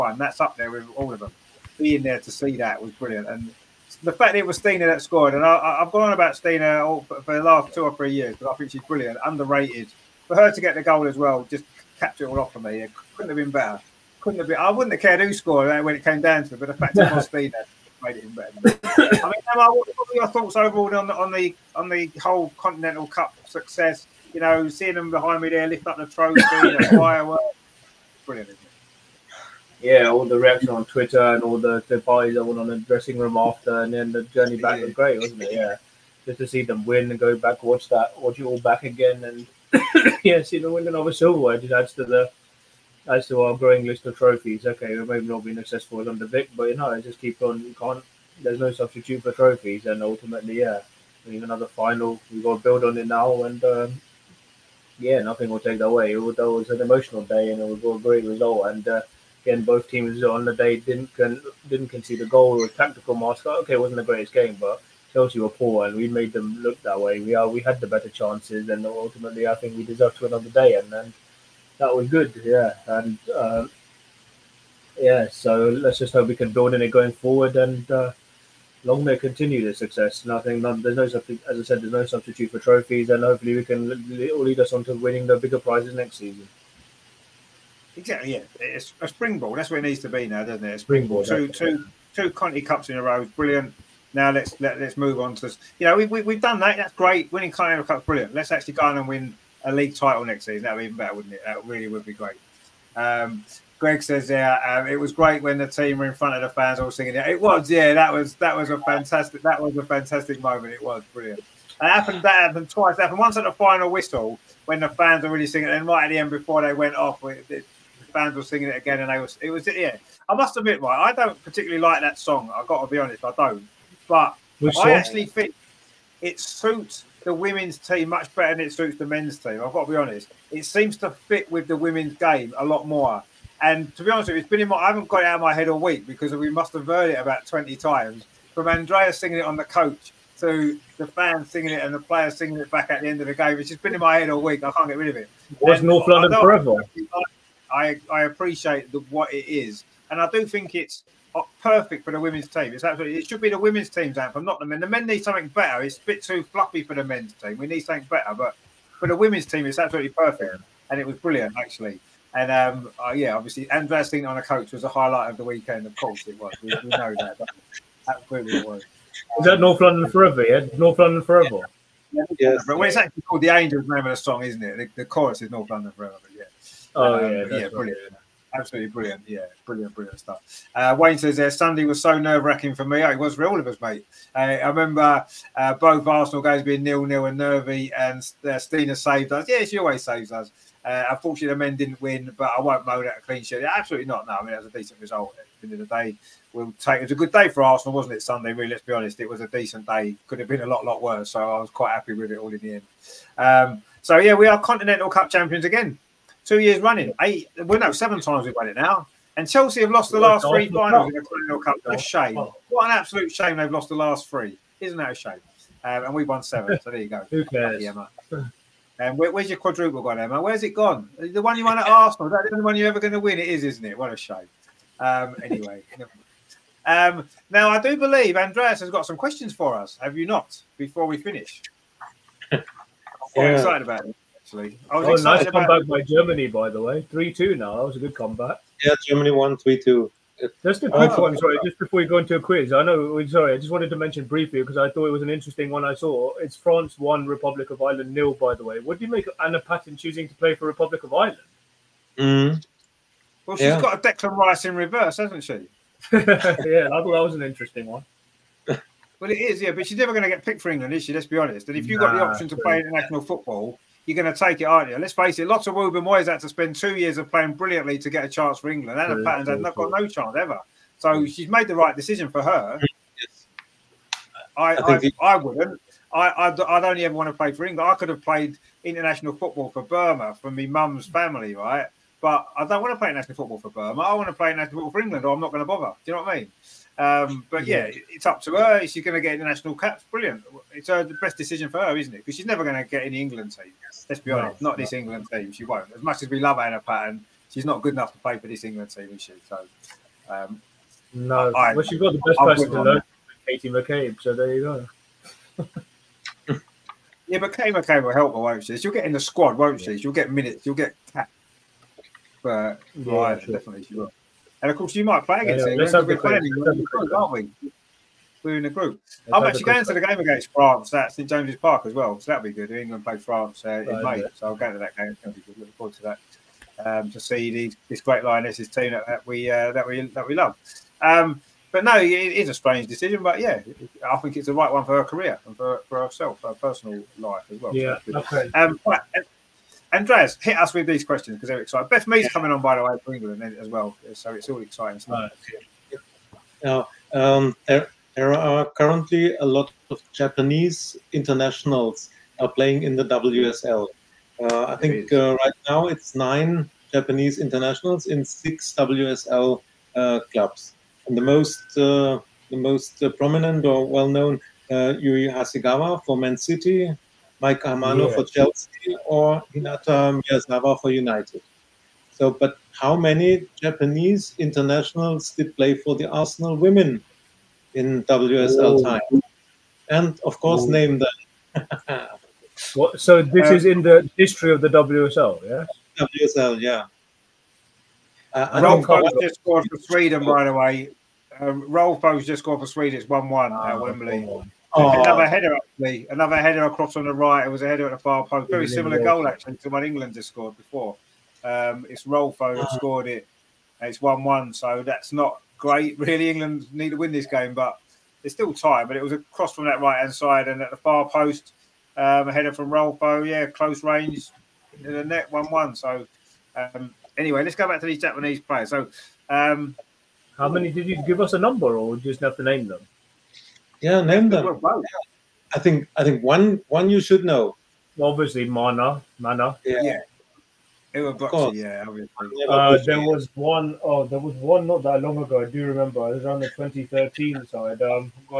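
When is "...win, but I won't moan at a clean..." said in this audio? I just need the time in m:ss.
3:12.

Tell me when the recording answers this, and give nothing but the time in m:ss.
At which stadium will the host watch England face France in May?
5:21.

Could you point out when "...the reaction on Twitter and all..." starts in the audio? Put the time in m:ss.
0:30.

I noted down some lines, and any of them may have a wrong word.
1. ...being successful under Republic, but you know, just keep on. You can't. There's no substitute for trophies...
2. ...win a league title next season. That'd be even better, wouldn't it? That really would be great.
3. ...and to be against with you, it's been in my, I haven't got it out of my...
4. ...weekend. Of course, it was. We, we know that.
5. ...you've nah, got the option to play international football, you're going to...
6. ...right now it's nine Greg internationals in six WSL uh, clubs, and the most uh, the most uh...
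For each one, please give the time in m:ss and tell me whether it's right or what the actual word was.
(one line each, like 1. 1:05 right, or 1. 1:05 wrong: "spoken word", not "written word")
1. 0:45 wrong: "Vic", not "Republic"
2. 1:39 right
3. 2:13 wrong: "honest", not "against"
4. 2:45 right
5. 4:21 right
6. 5:55 wrong: "Japanese", not "Greg".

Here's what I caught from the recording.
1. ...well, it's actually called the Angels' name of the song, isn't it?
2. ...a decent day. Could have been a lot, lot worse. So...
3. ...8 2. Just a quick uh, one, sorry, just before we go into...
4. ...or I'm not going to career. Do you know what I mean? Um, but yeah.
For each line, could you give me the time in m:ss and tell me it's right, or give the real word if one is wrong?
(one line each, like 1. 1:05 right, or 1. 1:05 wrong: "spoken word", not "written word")
1. 2:52 right
2. 3:19 right
3. 3:59 wrong: "3", not "8"
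4. 4:45 wrong: "bother", not "career".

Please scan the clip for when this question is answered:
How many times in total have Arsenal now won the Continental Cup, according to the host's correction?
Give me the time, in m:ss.
3:27.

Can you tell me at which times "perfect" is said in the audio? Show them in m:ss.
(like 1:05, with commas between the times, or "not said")
2:31, 2:40.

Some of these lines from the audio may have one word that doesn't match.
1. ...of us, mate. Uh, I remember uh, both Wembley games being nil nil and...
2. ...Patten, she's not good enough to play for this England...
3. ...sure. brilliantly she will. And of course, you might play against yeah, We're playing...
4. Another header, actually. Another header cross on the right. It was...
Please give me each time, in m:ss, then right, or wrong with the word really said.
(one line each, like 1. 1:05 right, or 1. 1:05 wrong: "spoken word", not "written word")
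1. 3:03 wrong: "Arsenal", not "Wembley"
2. 4:56 right
3. 5:13 wrong: "definitely", not "brilliantly"
4. 6:35 wrong: "across", not "cross".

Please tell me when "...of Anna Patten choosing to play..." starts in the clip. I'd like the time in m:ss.
4:09.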